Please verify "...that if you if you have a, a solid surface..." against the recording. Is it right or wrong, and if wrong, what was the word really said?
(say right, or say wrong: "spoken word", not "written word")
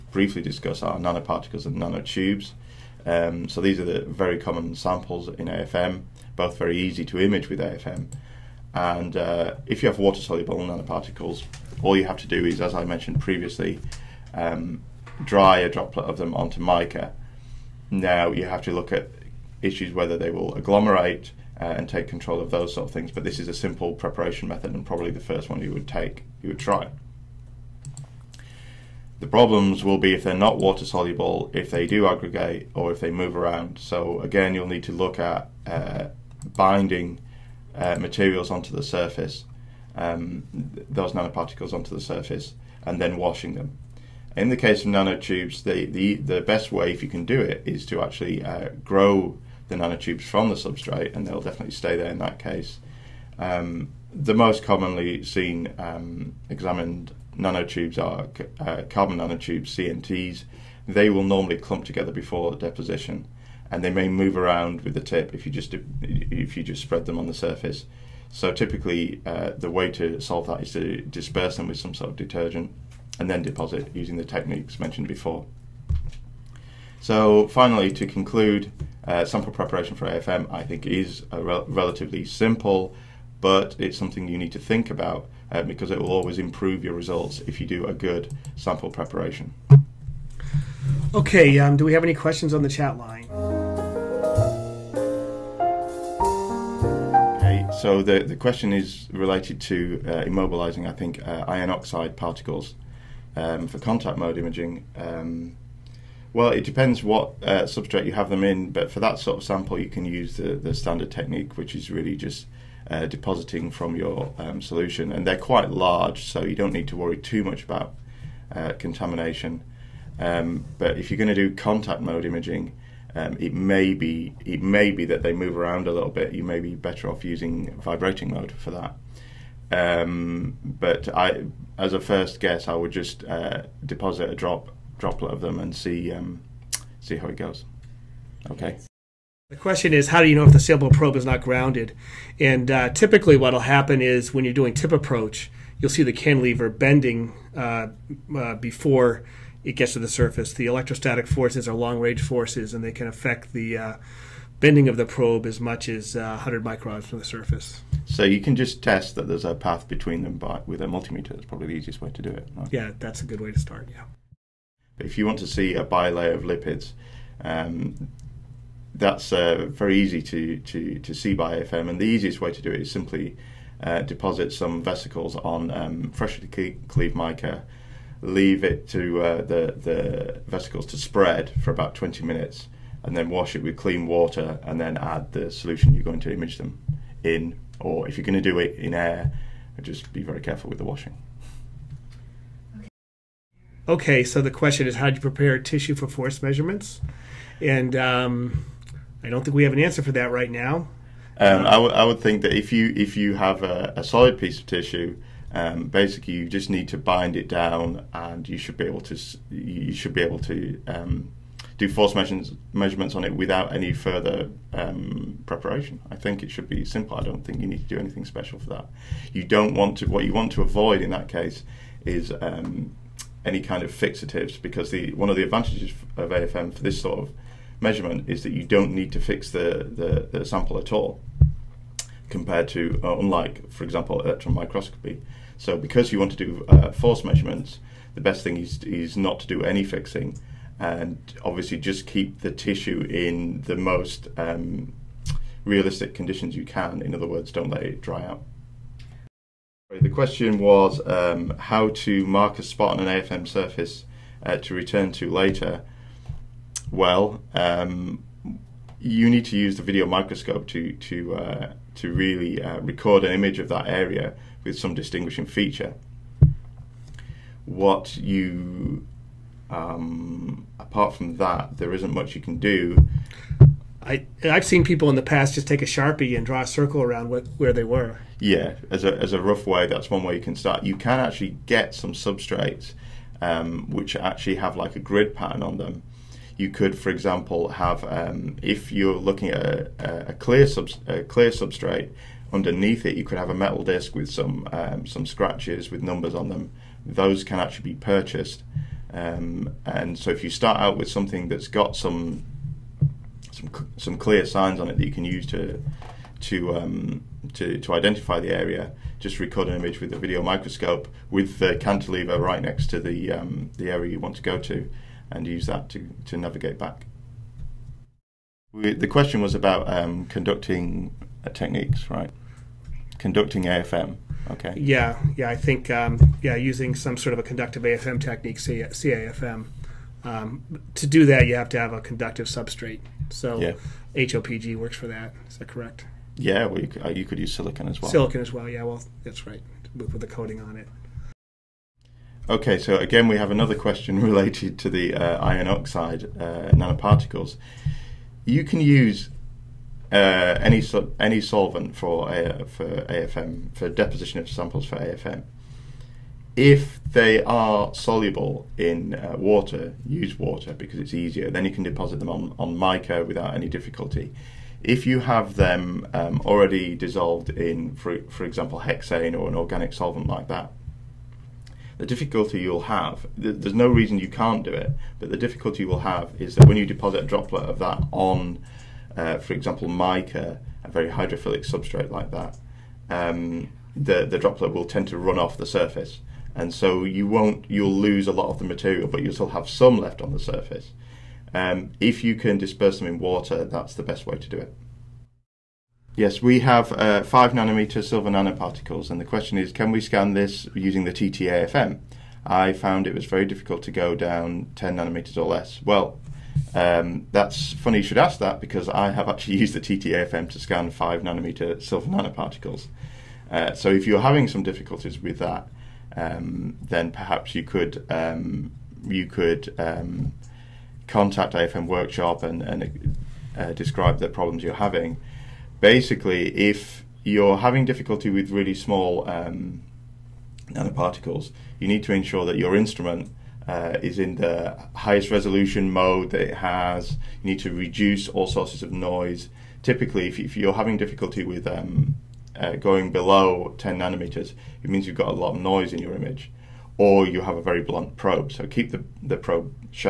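wrong: "piece", not "surface".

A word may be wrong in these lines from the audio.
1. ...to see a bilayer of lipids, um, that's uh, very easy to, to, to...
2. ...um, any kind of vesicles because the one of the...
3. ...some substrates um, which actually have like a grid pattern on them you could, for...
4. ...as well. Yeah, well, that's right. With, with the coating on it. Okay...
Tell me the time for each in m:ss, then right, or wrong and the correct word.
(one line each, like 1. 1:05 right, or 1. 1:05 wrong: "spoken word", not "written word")
1. 2:45 right
2. 3:42 wrong: "fixatives", not "vesicles"
3. 4:41 right
4. 5:38 right.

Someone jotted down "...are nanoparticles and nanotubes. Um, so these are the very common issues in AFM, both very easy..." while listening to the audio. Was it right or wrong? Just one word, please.
wrong.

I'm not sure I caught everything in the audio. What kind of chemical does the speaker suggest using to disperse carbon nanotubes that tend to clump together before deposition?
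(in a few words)
detergent.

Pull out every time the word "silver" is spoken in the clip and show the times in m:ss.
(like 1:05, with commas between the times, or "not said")
6:38, 6:51.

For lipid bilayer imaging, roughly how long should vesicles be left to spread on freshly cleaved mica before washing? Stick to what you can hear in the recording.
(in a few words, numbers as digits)
20 minutes.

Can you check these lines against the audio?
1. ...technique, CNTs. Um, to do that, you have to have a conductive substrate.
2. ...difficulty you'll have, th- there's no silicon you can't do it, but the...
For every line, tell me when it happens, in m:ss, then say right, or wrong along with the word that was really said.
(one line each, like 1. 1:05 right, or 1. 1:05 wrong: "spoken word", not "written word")
1. 5:28 wrong: "CAFM", not "CNTs"
2. 6:12 wrong: "reason", not "silicon".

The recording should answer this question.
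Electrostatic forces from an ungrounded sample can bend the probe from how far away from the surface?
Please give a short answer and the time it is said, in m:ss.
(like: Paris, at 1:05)
100 microns, at 2:36.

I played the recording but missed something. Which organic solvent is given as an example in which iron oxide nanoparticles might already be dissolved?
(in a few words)
hexane.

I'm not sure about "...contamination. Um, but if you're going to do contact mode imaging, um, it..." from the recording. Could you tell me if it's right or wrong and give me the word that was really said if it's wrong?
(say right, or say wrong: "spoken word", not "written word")
right.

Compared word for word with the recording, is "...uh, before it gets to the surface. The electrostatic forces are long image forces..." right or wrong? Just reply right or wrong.
wrong.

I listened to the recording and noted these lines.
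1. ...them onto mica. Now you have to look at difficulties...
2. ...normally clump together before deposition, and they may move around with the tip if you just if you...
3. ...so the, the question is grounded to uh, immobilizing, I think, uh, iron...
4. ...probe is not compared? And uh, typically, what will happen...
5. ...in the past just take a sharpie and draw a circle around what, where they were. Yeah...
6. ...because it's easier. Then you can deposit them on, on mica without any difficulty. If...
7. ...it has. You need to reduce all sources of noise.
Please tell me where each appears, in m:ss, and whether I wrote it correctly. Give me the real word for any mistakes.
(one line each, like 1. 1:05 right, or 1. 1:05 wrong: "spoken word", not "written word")
1. 0:16 wrong: "issues", not "difficulties"
2. 1:01 right
3. 1:37 wrong: "related", not "grounded"
4. 2:20 wrong: "grounded", not "compared"
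5. 4:35 right
6. 6:00 right
7. 7:16 right.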